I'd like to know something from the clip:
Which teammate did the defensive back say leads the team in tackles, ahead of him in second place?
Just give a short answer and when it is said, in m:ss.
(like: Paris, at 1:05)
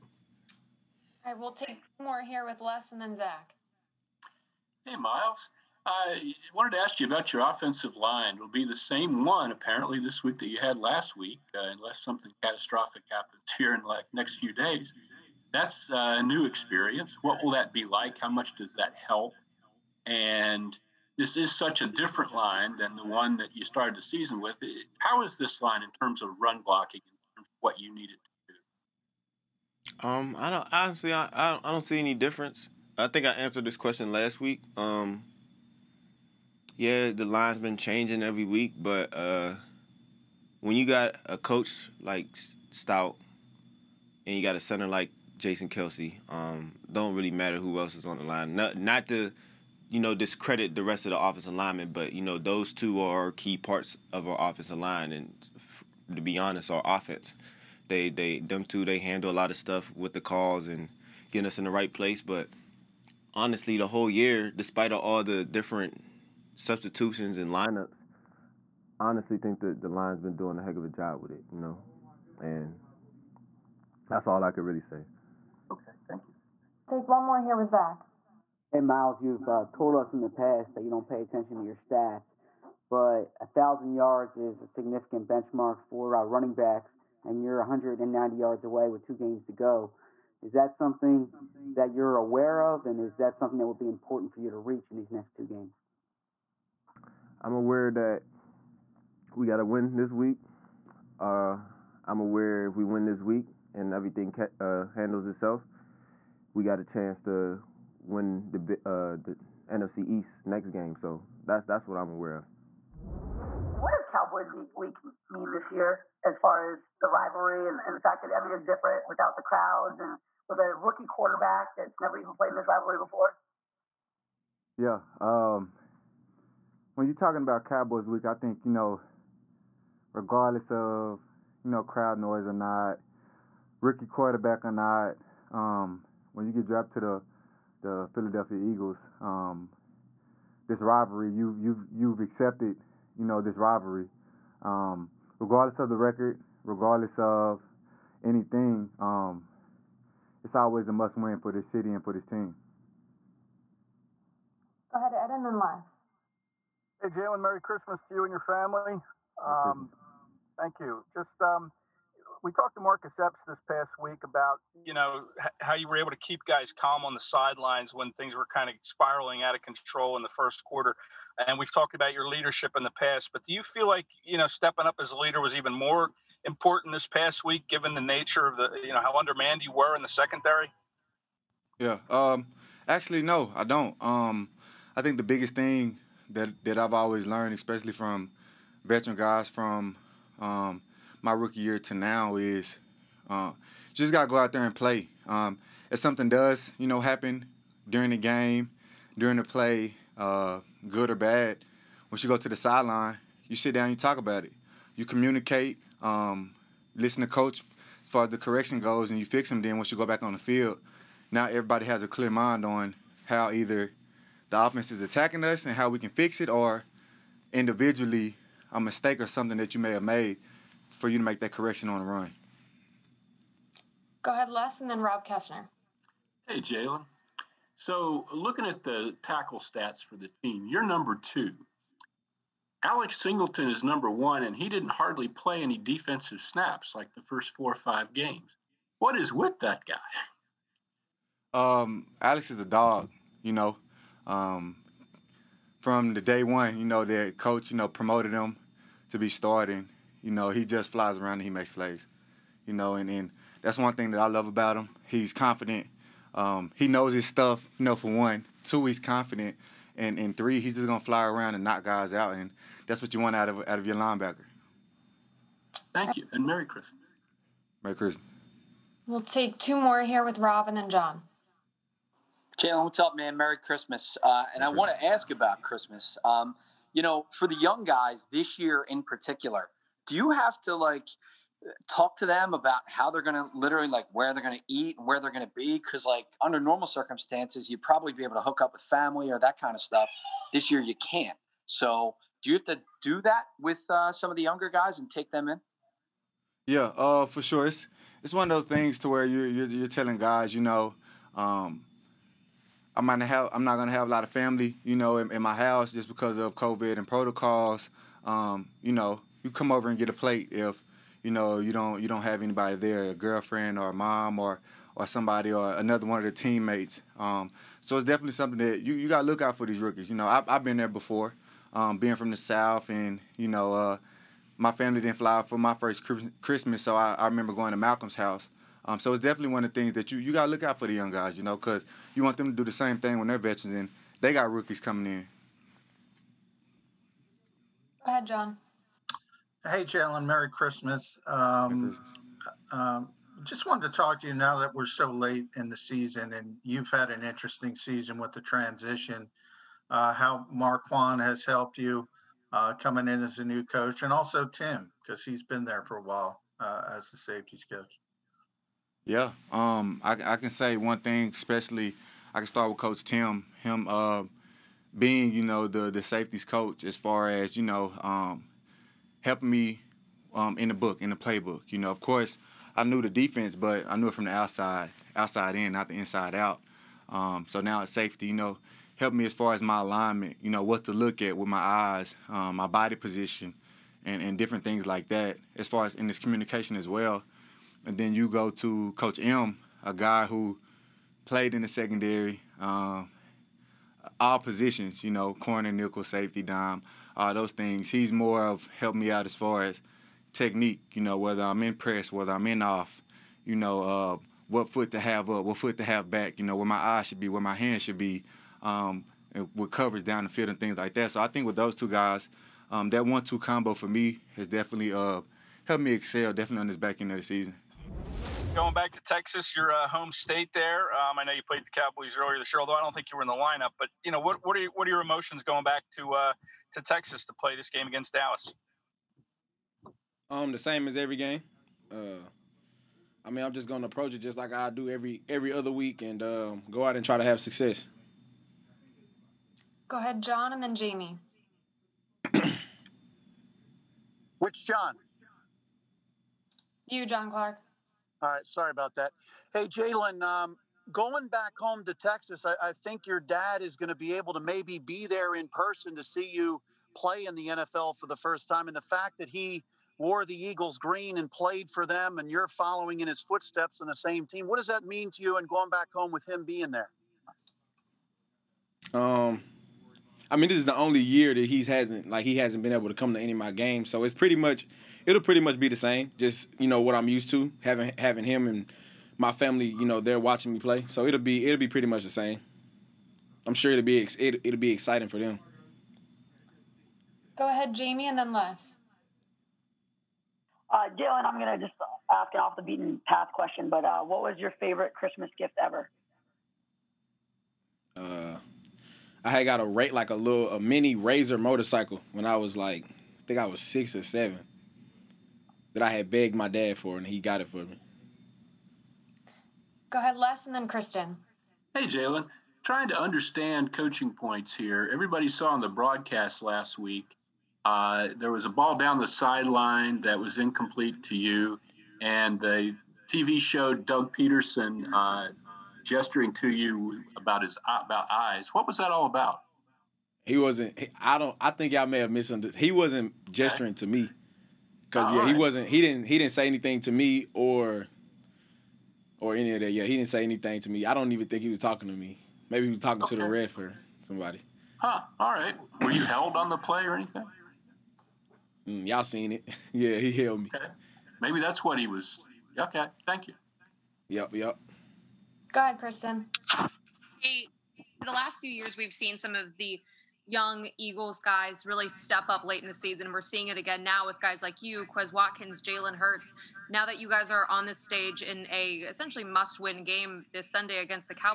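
Alex Singleton, at 3:52.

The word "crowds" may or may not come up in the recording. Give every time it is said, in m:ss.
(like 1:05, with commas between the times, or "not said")
1:59, 2:11.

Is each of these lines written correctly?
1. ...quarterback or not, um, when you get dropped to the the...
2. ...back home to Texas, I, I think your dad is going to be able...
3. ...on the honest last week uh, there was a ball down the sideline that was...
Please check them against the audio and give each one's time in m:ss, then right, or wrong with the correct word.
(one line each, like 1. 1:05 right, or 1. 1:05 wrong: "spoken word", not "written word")
1. 2:14 right
2. 7:31 right
3. 8:35 wrong: "broadcast", not "honest".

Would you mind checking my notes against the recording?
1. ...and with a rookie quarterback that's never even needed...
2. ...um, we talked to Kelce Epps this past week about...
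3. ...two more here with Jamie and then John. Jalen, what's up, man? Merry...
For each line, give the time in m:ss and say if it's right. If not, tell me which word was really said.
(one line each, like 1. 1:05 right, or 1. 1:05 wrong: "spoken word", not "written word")
1. 1:59 wrong: "played", not "needed"
2. 2:41 wrong: "Marcus", not "Kelce"
3. 4:29 wrong: "Rob", not "Jamie".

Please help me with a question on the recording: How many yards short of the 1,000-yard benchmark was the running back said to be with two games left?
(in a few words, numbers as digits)
190.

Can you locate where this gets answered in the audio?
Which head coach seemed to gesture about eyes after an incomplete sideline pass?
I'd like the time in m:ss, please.
8:43.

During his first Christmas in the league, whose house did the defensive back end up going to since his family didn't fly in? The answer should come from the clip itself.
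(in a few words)
Malcolm.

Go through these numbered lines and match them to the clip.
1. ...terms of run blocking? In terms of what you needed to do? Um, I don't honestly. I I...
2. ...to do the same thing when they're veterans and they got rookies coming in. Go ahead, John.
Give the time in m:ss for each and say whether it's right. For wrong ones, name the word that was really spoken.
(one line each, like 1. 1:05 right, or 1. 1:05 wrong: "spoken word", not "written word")
1. 0:26 right
2. 5:32 right.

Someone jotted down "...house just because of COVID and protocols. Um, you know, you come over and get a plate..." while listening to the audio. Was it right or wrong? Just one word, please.
right.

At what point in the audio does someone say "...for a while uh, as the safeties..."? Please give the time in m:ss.
5:55.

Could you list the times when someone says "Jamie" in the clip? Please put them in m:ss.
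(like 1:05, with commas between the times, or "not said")
7:20, 8:07.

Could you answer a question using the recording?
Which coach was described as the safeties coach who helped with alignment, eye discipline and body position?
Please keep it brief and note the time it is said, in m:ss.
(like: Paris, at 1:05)
Coach Tim, at 6:02.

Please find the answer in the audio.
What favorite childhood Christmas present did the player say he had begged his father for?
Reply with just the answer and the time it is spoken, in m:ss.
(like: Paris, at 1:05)
Mini Razor motorcycle, at 8:20.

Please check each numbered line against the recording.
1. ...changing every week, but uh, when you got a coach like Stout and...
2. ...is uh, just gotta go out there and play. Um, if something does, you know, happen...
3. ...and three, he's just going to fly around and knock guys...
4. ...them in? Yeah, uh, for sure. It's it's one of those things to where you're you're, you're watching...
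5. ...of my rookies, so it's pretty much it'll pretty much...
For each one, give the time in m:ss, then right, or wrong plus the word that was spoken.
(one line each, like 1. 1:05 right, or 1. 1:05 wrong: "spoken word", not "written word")
1. 0:37 right
2. 3:12 right
3. 4:20 right
4. 4:55 wrong: "telling", not "watching"
5. 7:53 wrong: "games", not "rookies".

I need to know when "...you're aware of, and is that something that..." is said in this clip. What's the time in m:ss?
1:31.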